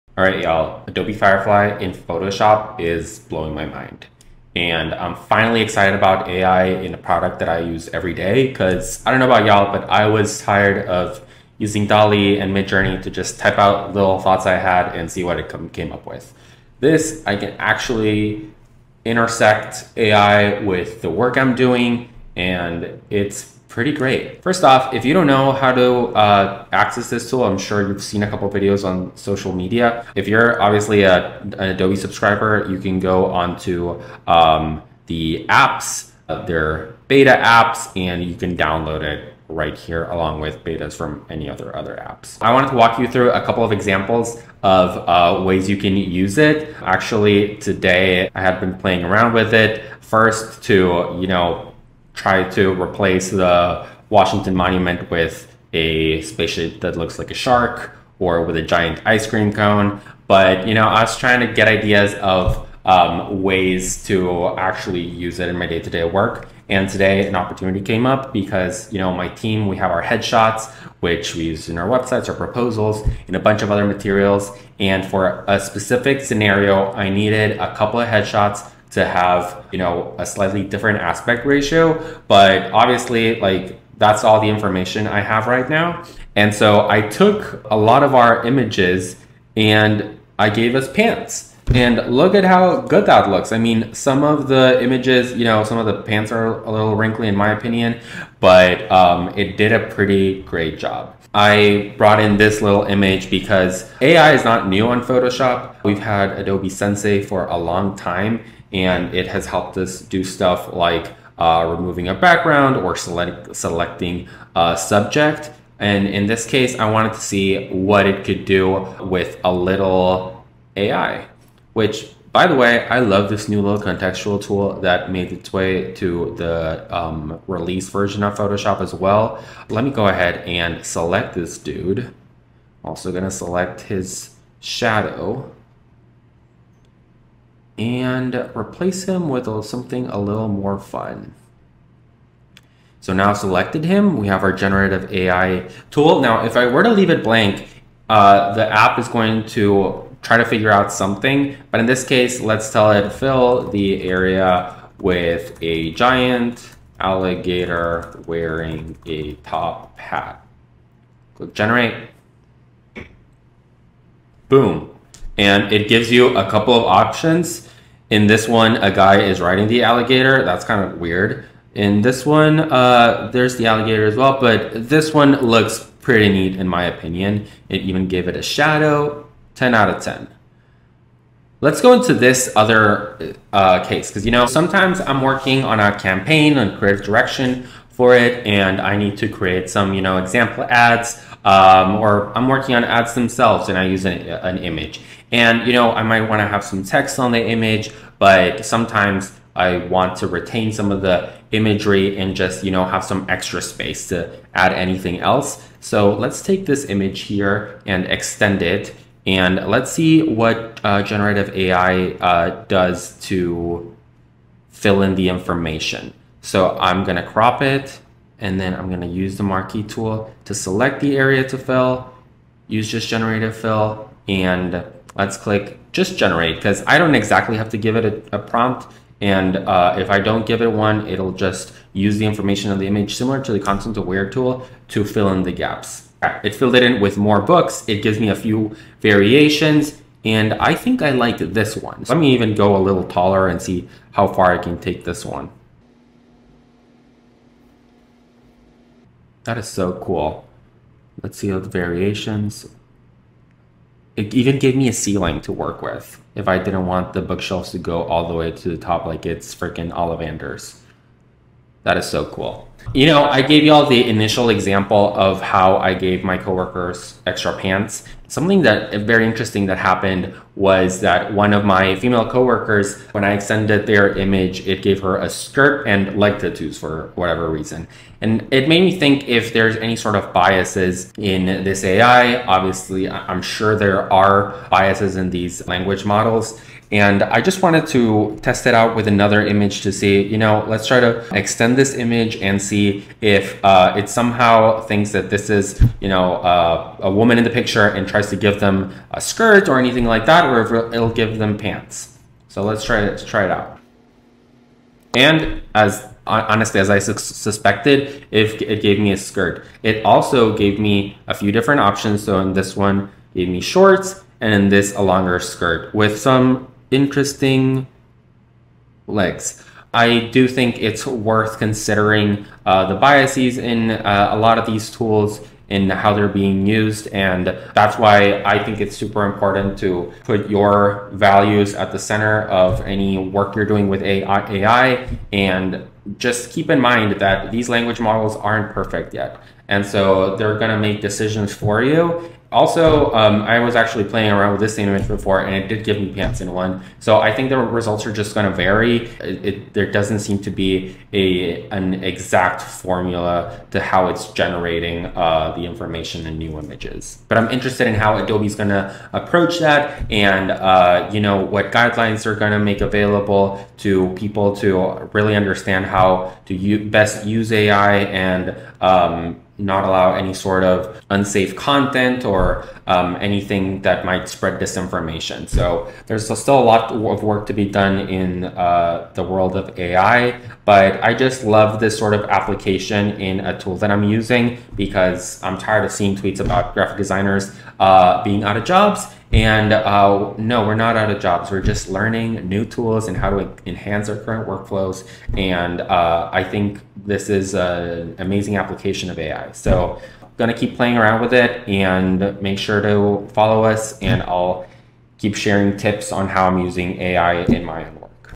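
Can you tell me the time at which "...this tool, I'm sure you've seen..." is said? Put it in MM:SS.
00:27.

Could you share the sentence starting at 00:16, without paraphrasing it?
This, I can actually intersect AI with the work I'm doing, and it's pretty great.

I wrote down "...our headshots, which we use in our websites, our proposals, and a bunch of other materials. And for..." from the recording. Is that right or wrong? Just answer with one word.
right.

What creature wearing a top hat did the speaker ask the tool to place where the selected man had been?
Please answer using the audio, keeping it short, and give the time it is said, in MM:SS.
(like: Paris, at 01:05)
giant alligator, at 02:35.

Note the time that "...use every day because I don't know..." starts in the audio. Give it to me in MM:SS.
00:07.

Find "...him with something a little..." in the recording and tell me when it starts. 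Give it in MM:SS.
02:19.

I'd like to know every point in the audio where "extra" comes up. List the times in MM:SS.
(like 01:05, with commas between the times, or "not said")
03:23, 04:27.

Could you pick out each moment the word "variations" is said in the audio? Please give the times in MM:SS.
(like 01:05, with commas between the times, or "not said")
03:59, 04:11.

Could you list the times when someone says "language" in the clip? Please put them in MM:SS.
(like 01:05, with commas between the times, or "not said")
04:45, 05:37.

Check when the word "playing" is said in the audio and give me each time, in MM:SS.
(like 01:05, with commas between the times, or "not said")
00:48, 05:44, 06:40.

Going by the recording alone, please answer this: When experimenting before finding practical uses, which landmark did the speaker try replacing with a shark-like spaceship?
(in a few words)
Washington Monument.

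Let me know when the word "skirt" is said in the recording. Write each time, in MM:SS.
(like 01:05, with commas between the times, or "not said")
04:35, 04:59, 05:09, 05:15.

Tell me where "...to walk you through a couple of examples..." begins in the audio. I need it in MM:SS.
00:42.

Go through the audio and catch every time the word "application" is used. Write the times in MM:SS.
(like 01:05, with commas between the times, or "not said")
06:22, 06:38.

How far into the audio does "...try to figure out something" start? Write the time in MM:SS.
02:30.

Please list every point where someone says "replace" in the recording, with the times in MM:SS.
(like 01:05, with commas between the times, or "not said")
00:52, 02:18.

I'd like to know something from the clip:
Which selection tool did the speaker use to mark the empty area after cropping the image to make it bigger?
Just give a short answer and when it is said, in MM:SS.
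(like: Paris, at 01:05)
marquee tool, at 03:39.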